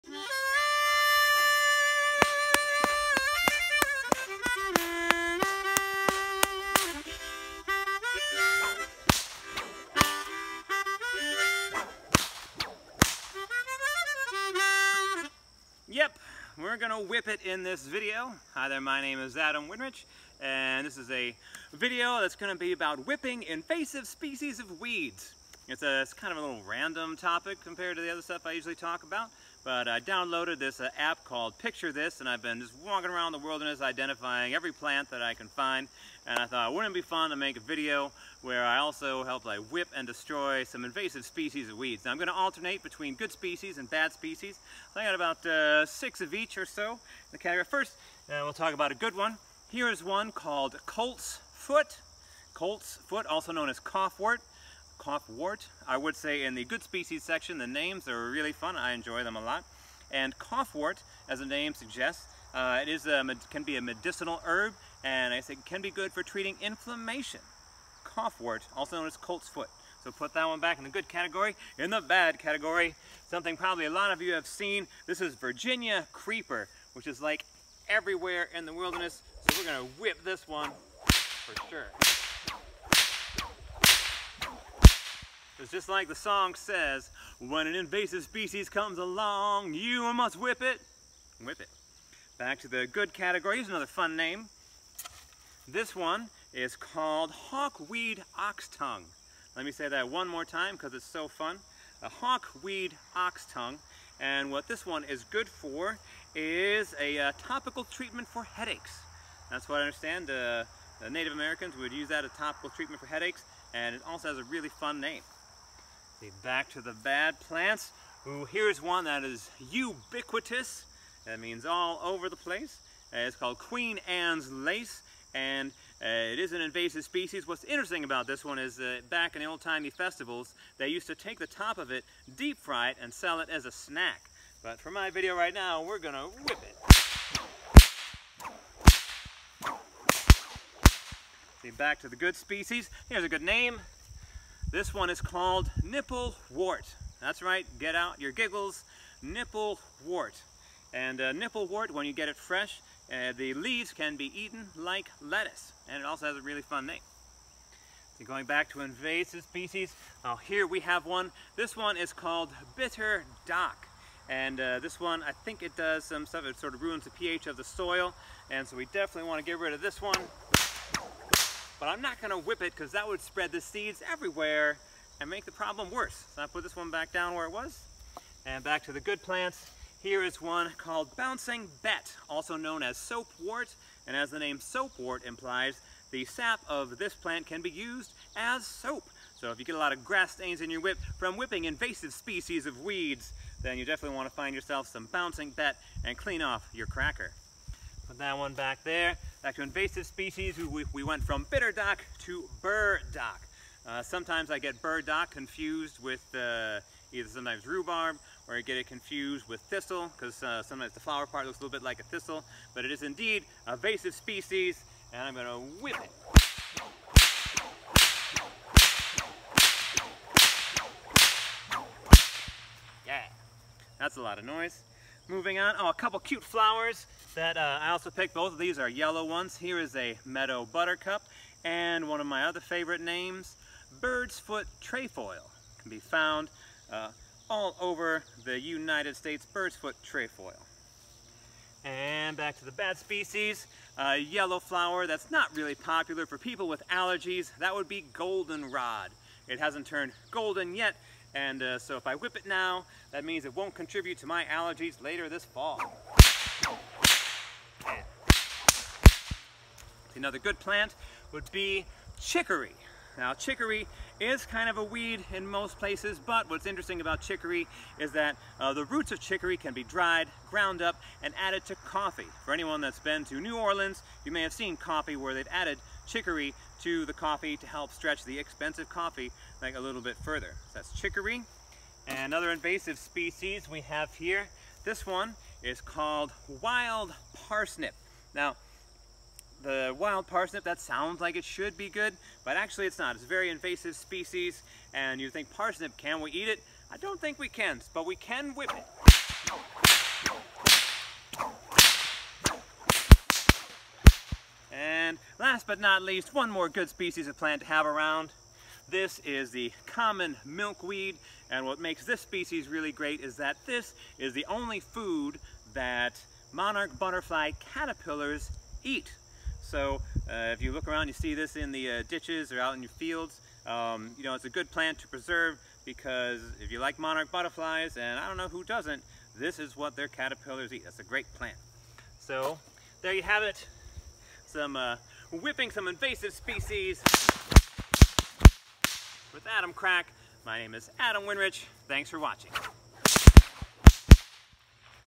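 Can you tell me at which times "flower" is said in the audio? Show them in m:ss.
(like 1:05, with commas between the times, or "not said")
3:30, 3:46, 4:04.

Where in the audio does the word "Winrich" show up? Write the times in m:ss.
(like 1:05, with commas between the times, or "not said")
0:19, 5:41.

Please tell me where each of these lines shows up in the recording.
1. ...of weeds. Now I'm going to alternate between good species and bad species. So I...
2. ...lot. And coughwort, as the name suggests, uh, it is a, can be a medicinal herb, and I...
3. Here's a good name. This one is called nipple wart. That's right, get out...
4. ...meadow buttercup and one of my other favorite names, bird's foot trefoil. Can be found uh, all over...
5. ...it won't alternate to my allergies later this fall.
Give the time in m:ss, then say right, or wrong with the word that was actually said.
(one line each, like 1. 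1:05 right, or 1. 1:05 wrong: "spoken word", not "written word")
1. 0:41 right
2. 0:59 right
3. 2:23 right
4. 3:50 right
5. 4:13 wrong: "contribute", not "alternate".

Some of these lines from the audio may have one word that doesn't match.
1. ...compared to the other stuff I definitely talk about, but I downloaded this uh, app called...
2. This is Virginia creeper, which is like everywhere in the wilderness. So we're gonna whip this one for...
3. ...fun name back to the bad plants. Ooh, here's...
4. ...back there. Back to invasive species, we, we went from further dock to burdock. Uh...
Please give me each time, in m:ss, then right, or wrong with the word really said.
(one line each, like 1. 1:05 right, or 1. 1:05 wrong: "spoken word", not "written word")
1. 0:27 wrong: "usually", not "definitely"
2. 1:15 right
3. 1:54 right
4. 3:18 wrong: "bitter", not "further".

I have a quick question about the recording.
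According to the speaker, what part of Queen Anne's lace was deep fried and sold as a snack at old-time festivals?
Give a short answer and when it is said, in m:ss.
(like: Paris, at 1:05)
the top, at 2:11.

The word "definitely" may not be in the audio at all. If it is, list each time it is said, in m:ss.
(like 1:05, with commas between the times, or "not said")
2:48, 3:13.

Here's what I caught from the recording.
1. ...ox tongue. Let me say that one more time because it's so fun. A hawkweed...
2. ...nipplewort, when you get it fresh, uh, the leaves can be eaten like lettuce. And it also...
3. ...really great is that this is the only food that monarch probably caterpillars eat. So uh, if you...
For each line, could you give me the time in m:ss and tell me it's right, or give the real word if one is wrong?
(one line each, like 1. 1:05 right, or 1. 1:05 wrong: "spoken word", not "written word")
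1. 1:38 right
2. 2:31 right
3. 5:12 wrong: "butterfly", not "probably".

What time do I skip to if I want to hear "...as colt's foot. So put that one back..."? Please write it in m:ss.
1:09.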